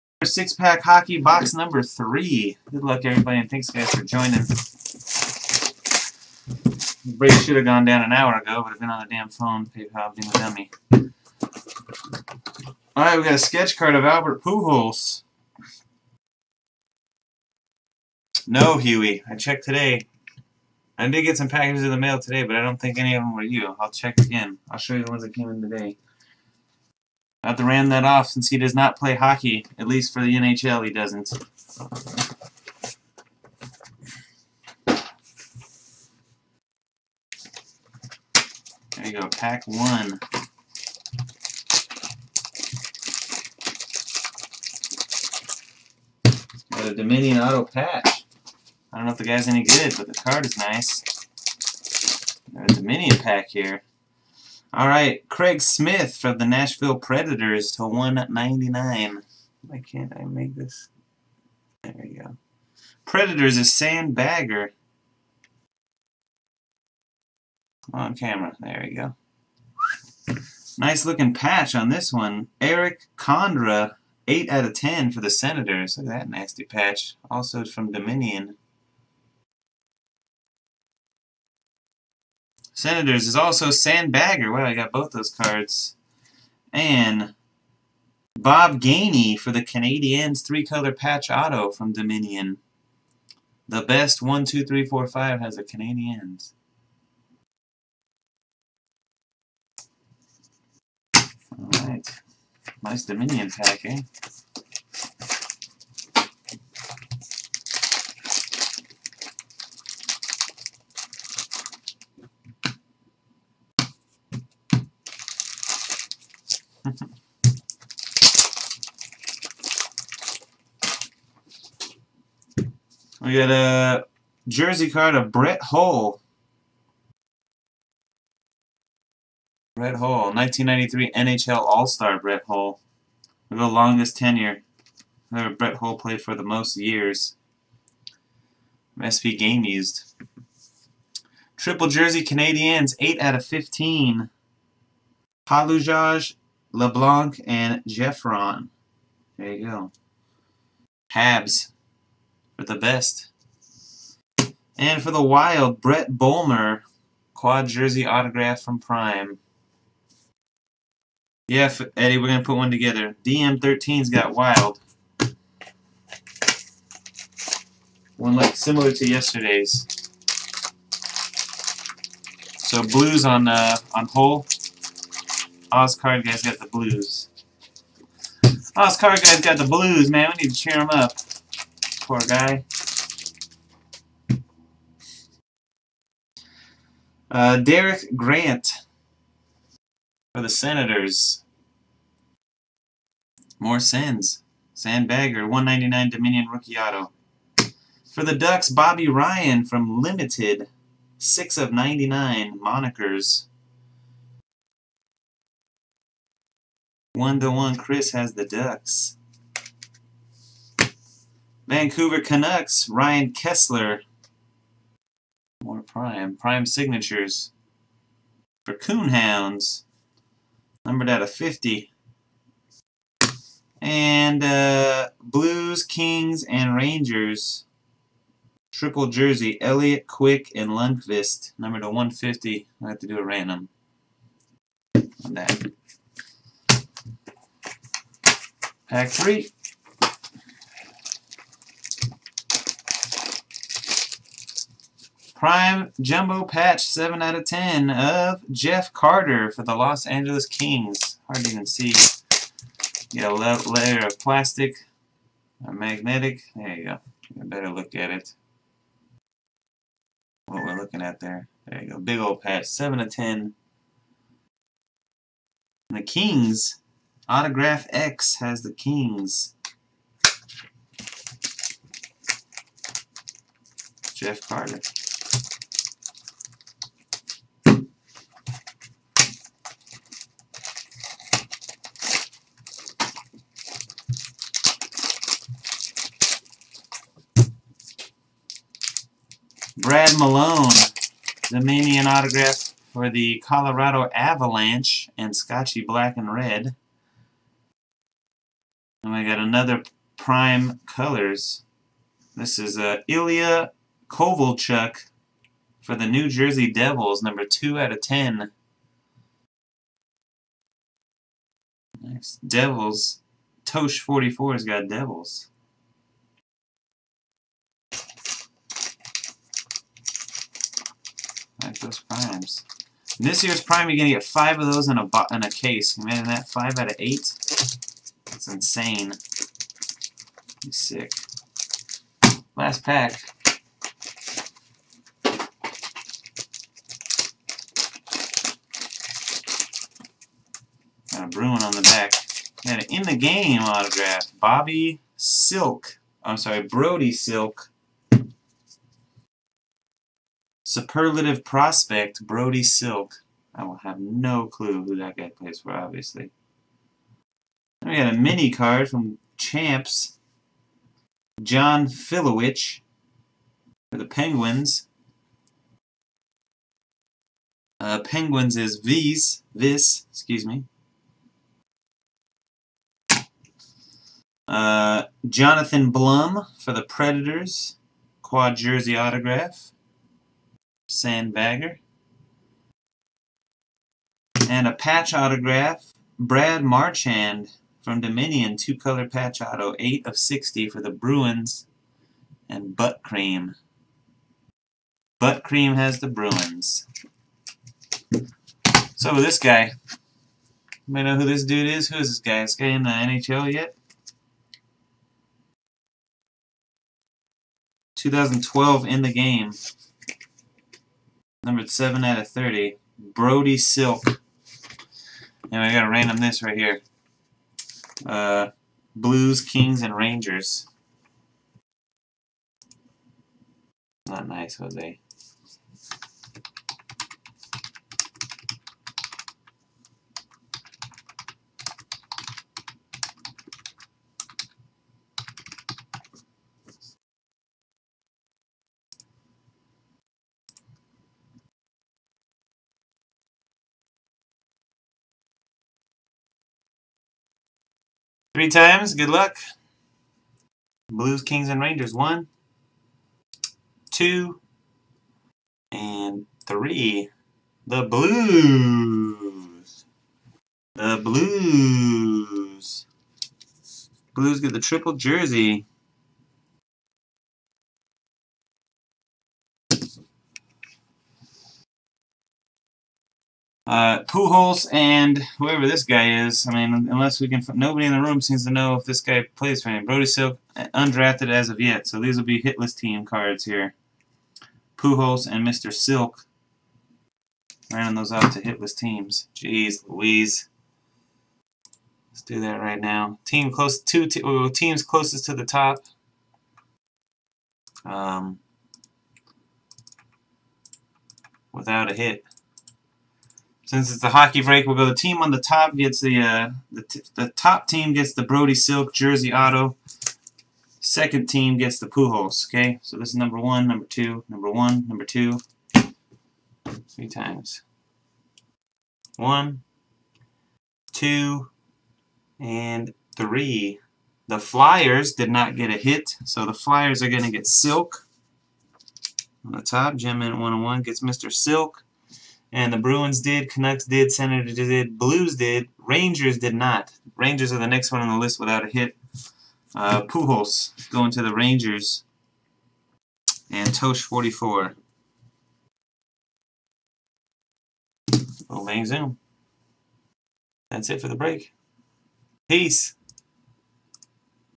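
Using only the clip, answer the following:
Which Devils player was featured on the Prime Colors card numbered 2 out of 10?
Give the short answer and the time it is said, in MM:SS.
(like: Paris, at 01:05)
Ilya Kovalchuk, at 05:03.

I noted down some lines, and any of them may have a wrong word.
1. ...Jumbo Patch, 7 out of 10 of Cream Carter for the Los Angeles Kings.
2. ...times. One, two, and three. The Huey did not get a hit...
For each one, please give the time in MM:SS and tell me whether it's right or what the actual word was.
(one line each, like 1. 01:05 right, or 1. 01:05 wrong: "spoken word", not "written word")
1. 04:05 wrong: "Jeff", not "Cream"
2. 08:37 wrong: "Flyers", not "Huey".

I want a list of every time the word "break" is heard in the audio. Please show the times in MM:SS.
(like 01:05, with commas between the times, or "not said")
00:07, 08:24, 09:11.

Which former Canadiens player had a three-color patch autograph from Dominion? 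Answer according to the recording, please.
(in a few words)
Bob Gainey.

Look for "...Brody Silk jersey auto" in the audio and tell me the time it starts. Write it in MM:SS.
08:28.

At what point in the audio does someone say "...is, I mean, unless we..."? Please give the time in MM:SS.
07:56.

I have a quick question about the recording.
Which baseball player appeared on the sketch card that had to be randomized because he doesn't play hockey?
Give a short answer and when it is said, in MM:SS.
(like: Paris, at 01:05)
Albert Pujols, at 00:14.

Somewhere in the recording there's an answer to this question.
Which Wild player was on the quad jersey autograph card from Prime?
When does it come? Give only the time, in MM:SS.
02:35.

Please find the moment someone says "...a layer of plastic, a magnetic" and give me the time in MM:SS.
04:13.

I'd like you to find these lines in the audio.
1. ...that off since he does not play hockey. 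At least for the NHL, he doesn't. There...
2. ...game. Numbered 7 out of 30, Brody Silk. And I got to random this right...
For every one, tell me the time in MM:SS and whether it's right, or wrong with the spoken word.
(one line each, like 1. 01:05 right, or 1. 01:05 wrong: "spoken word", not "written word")
1. 00:27 right
2. 06:49 right.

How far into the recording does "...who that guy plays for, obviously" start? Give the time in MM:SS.
05:54.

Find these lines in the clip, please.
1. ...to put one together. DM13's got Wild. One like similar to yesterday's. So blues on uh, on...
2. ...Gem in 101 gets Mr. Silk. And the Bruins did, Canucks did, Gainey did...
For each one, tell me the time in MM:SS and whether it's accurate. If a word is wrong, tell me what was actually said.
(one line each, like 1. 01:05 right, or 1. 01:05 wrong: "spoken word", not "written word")
1. 02:42 right
2. 08:49 wrong: "Senators", not "Gainey".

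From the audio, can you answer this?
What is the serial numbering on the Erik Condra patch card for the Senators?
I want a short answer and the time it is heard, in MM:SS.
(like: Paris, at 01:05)
8 out of 10, at 01:14.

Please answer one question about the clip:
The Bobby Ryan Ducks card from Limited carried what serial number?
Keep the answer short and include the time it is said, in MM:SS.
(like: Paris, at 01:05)
6 of 99, at 03:21.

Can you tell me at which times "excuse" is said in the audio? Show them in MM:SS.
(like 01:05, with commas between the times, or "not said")
06:10.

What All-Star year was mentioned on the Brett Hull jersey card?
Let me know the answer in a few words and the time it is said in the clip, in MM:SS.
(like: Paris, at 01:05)
1993, at 02:10.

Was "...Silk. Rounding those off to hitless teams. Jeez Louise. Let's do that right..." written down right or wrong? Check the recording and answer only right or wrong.
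right.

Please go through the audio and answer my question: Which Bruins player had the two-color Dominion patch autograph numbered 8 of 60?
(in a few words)
Brad Marchand.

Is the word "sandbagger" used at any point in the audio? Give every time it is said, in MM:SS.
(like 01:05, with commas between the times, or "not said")
01:03, 01:23, 03:14, 06:20.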